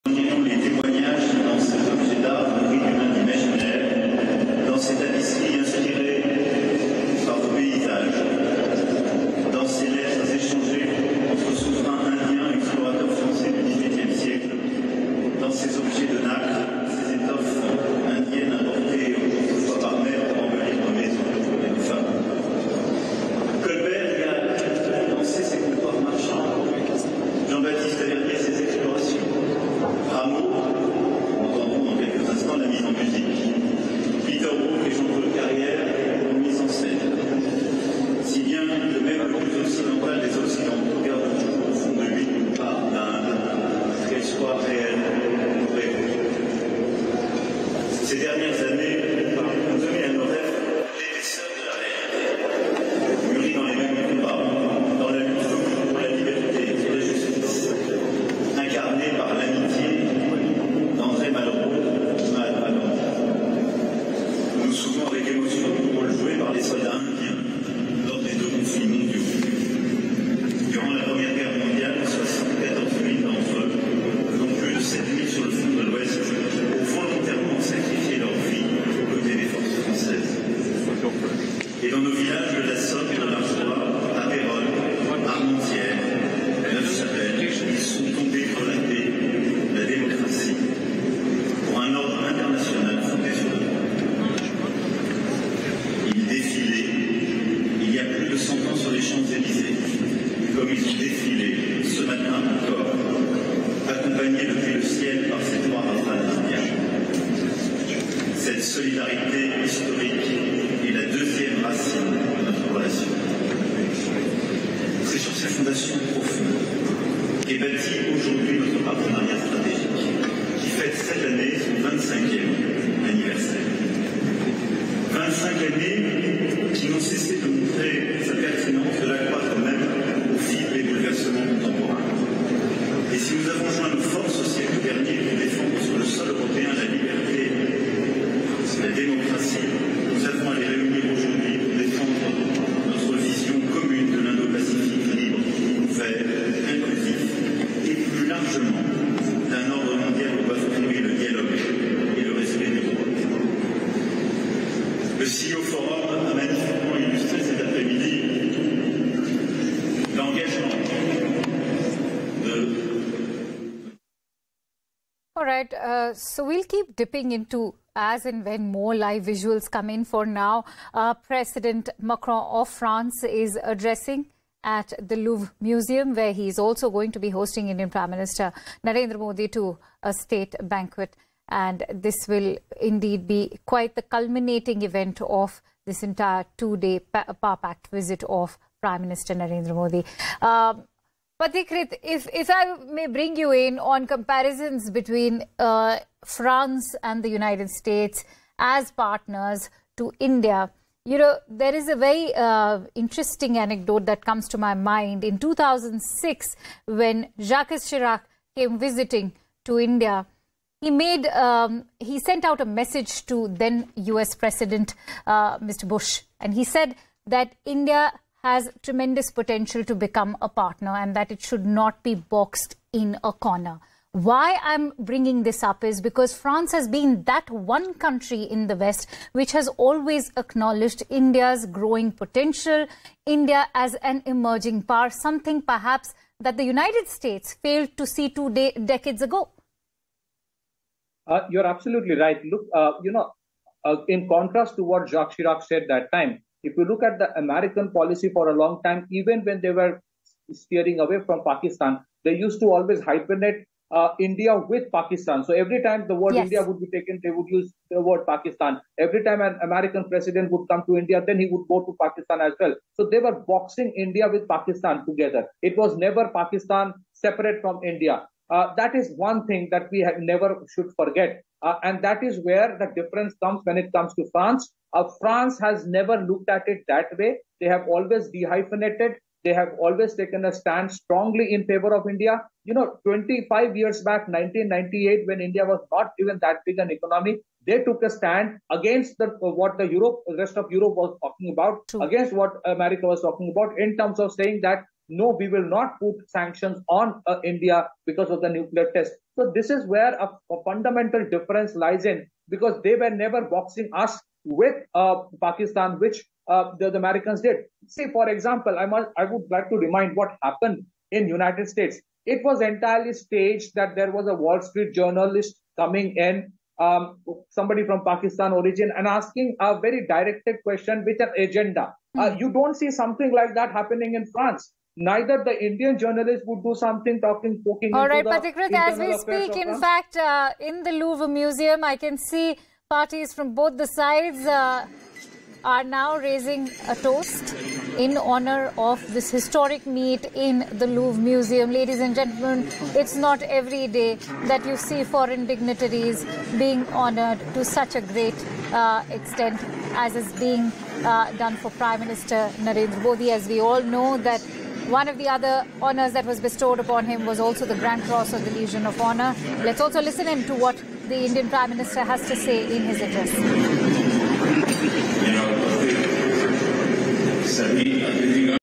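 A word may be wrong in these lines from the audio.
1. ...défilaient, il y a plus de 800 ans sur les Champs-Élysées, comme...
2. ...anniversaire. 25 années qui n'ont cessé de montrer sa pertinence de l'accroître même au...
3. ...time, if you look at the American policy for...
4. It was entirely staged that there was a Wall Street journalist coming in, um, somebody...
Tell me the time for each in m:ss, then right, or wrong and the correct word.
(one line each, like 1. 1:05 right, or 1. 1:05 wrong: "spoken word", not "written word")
1. 1:36 wrong: "100", not "800"
2. 2:03 right
3. 4:06 right
4. 5:12 right.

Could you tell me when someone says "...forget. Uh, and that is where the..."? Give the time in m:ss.
4:30.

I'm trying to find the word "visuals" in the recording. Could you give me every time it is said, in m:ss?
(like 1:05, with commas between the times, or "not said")
2:49.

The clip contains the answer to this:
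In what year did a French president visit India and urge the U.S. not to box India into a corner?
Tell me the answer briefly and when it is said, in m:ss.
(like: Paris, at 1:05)
2006, at 3:25.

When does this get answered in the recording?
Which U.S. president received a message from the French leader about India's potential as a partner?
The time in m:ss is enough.
3:35.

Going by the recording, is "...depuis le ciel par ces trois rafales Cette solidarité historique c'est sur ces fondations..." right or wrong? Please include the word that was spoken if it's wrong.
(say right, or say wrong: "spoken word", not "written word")
right.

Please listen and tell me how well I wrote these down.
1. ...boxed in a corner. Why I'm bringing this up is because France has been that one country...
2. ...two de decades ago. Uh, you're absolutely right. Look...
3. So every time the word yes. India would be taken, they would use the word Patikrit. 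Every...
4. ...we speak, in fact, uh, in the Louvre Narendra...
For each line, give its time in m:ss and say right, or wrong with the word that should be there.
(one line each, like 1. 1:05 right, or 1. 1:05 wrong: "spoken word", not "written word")
1. 3:42 right
2. 3:58 right
3. 4:15 wrong: "Pakistan", not "Patikrit"
4. 5:28 wrong: "Museum", not "Narendra".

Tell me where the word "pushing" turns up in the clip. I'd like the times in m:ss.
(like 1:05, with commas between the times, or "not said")
not said.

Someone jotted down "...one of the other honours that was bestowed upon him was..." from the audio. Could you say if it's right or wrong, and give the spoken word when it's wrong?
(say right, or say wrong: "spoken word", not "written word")
right.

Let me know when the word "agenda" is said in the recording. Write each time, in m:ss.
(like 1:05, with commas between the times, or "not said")
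5:21.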